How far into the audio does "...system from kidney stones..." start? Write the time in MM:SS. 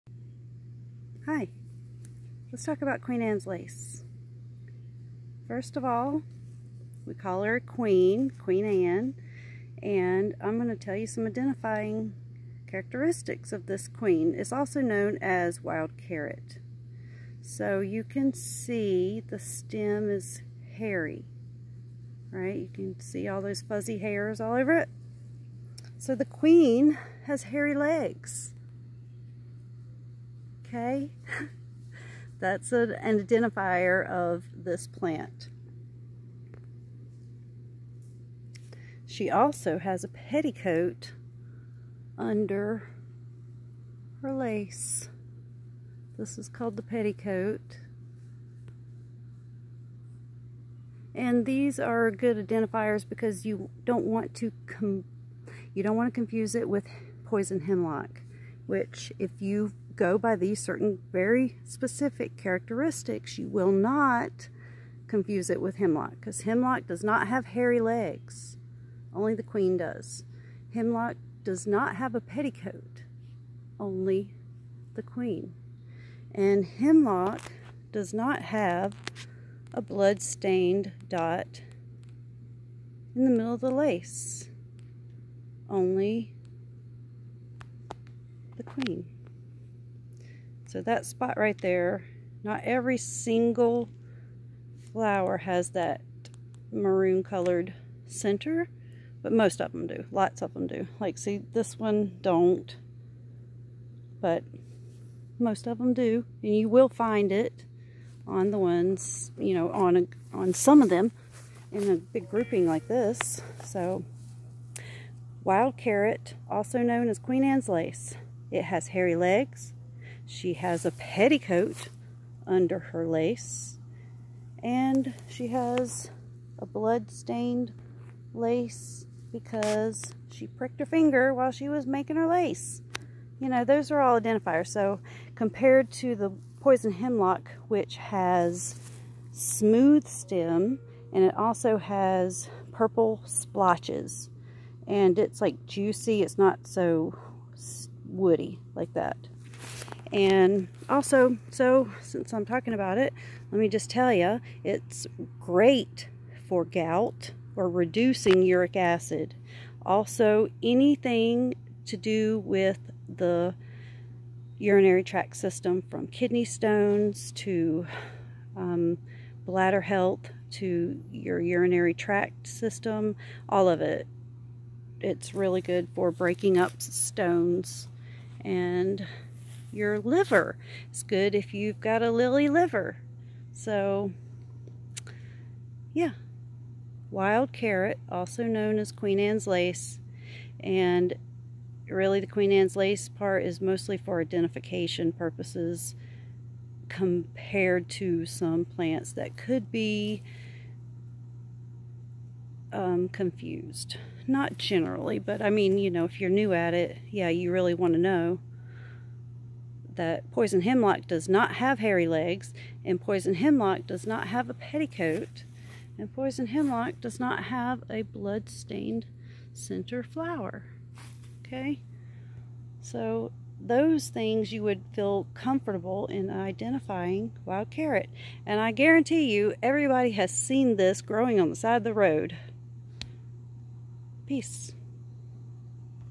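02:45.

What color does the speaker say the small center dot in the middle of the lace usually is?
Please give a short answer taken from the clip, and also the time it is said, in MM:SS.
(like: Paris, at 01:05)
Maroon, at 01:36.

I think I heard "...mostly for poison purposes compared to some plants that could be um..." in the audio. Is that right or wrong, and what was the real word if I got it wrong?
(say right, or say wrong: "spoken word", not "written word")
wrong: "identification", not "poison".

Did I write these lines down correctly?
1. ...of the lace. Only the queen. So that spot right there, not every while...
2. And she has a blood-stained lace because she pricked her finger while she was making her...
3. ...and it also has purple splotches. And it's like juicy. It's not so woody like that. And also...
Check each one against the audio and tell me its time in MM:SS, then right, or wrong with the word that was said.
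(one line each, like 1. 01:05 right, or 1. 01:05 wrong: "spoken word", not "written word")
1. 01:23 wrong: "single", not "while"
2. 02:04 right
3. 02:21 right.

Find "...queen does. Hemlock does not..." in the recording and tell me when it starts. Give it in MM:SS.
01:09.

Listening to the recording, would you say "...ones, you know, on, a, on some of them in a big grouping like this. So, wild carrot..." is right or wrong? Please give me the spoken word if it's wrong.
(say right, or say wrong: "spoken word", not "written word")
right.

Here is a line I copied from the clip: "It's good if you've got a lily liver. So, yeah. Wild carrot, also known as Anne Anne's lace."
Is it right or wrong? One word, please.
wrong.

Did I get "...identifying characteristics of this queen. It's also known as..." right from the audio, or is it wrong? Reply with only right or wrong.
right.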